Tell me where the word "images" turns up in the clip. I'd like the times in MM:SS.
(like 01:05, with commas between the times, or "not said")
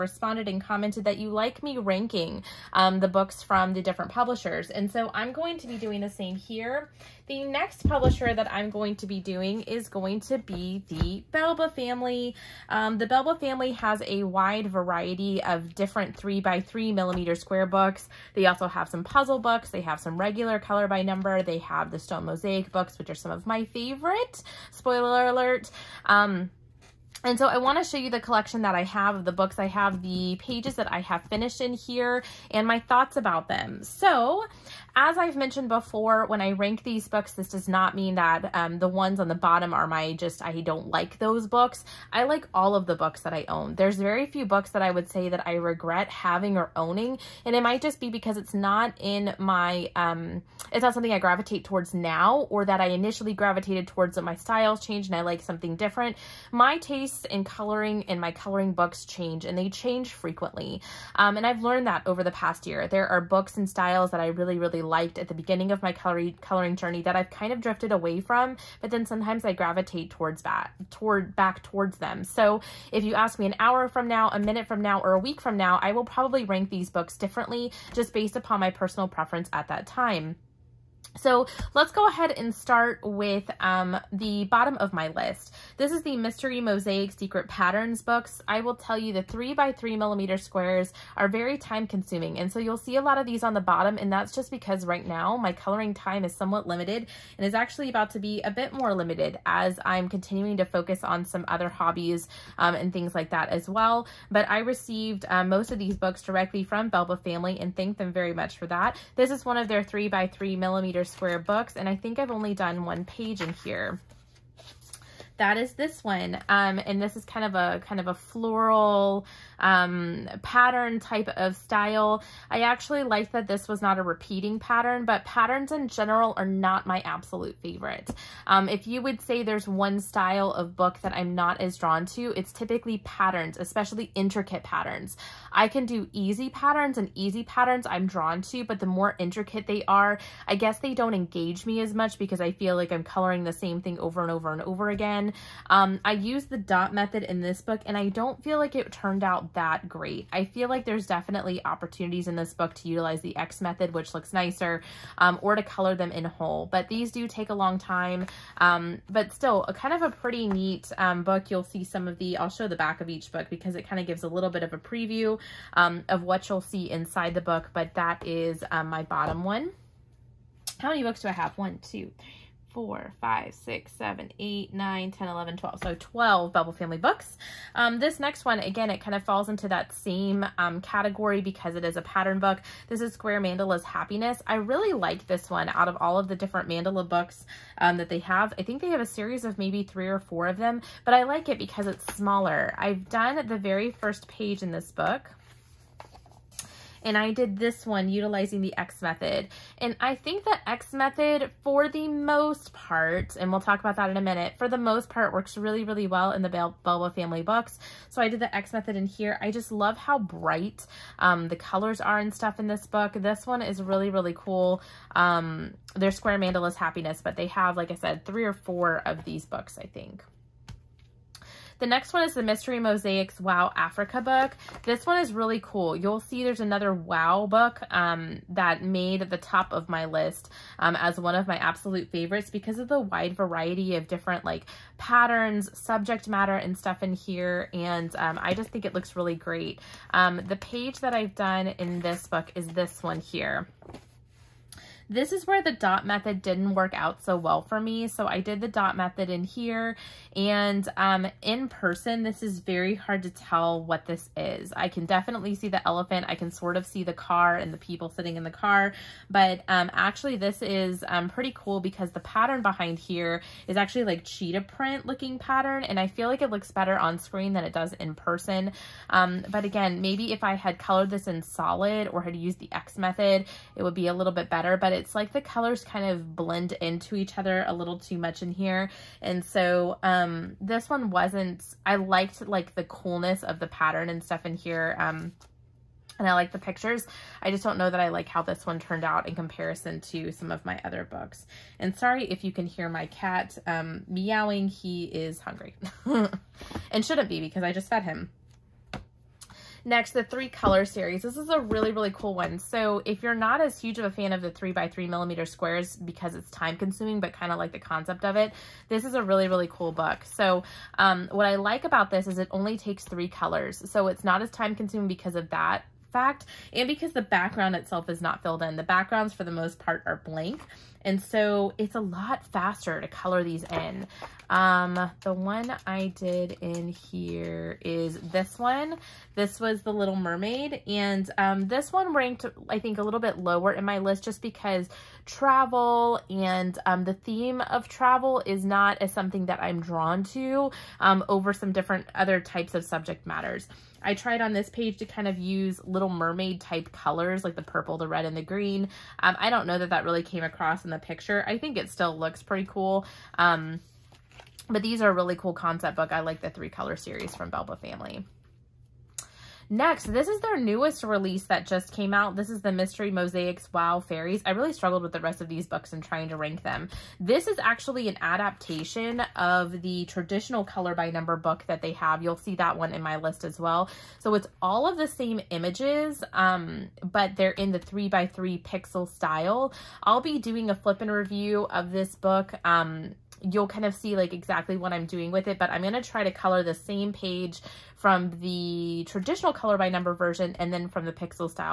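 06:15.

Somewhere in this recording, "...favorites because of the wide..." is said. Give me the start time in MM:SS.
03:52.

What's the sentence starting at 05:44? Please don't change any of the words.
I tried on this page to kind of use Little Mermaid type colors like the purple, the red, and the green.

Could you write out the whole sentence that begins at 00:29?
I have the pages that I have finished in here and my thoughts about them.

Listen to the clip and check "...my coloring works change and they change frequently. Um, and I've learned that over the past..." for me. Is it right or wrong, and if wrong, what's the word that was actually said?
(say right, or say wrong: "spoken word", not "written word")
wrong: "books", not "works".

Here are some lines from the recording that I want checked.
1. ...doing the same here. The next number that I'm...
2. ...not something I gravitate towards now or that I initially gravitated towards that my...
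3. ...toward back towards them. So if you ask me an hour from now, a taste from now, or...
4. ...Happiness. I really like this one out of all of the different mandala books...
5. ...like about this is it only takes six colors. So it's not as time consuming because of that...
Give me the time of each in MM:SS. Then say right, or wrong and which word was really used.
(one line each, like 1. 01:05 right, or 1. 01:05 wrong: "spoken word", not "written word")
1. 00:05 wrong: "publisher", not "number"
2. 00:50 right
3. 01:10 wrong: "minute", not "taste"
4. 03:03 right
5. 05:11 wrong: "three", not "six".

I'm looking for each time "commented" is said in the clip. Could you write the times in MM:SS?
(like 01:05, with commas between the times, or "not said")
00:00.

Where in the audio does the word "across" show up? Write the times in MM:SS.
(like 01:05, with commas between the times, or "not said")
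05:50.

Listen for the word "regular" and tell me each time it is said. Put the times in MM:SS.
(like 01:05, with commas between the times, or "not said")
00:20.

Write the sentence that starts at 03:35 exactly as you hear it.
Um, they're Square Mandala's Happiness, but they have, like I said, three or four of these books, I think.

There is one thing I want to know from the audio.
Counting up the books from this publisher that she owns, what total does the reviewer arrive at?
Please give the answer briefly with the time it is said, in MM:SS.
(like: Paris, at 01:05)
12, at 02:55.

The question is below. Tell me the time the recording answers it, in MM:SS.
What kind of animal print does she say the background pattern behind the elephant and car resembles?
04:24.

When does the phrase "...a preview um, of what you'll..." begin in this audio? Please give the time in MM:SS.
02:44.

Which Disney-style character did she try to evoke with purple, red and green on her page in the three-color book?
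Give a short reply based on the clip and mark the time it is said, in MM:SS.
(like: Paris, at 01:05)
The Little Mermaid, at 05:29.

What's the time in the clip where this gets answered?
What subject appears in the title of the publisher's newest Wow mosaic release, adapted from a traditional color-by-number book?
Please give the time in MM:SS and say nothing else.
06:04.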